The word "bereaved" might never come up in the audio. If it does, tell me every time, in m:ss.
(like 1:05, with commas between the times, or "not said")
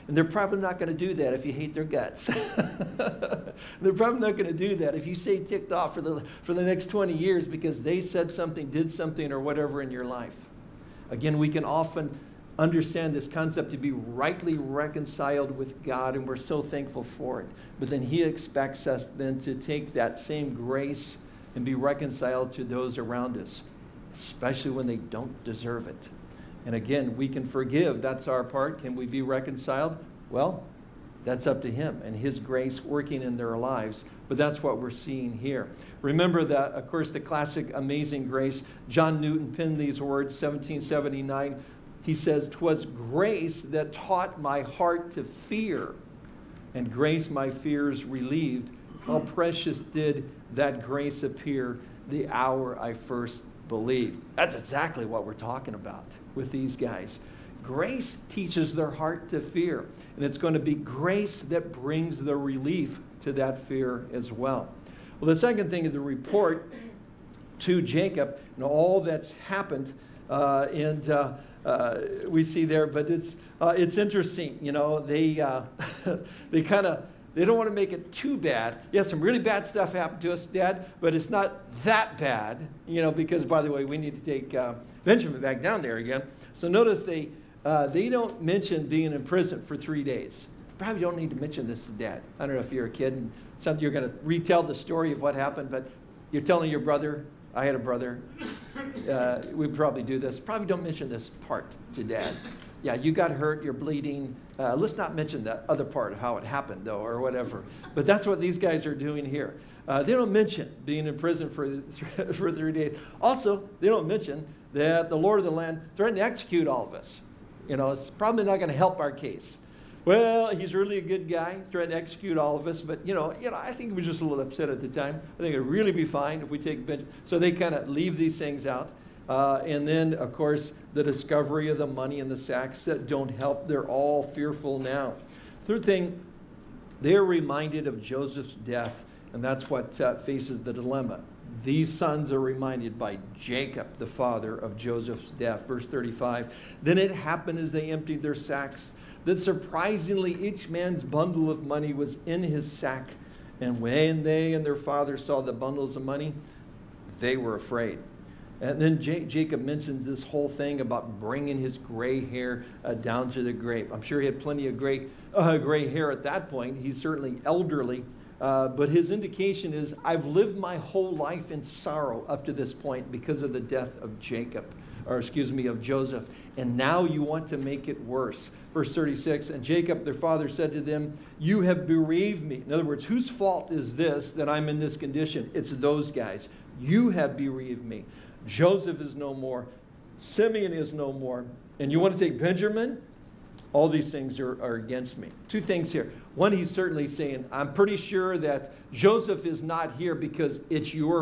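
3:01, 3:07.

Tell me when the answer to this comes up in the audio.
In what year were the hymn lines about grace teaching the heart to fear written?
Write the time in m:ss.
0:40.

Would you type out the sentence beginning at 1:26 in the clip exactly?
So notice they, uh, they don't mention being in prison for three days.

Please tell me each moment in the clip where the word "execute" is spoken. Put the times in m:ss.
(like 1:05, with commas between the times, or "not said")
1:56, 2:01.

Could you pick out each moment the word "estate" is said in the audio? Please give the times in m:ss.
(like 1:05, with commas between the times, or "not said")
not said.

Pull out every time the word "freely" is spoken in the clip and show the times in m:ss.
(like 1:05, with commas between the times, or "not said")
not said.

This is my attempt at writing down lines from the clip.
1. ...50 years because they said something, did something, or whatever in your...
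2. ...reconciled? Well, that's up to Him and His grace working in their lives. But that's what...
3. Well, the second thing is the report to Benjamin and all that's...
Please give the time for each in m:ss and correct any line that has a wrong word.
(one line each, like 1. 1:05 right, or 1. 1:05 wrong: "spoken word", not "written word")
1. 0:06 wrong: "20", not "50"
2. 0:29 right
3. 1:05 wrong: "Jacob", not "Benjamin".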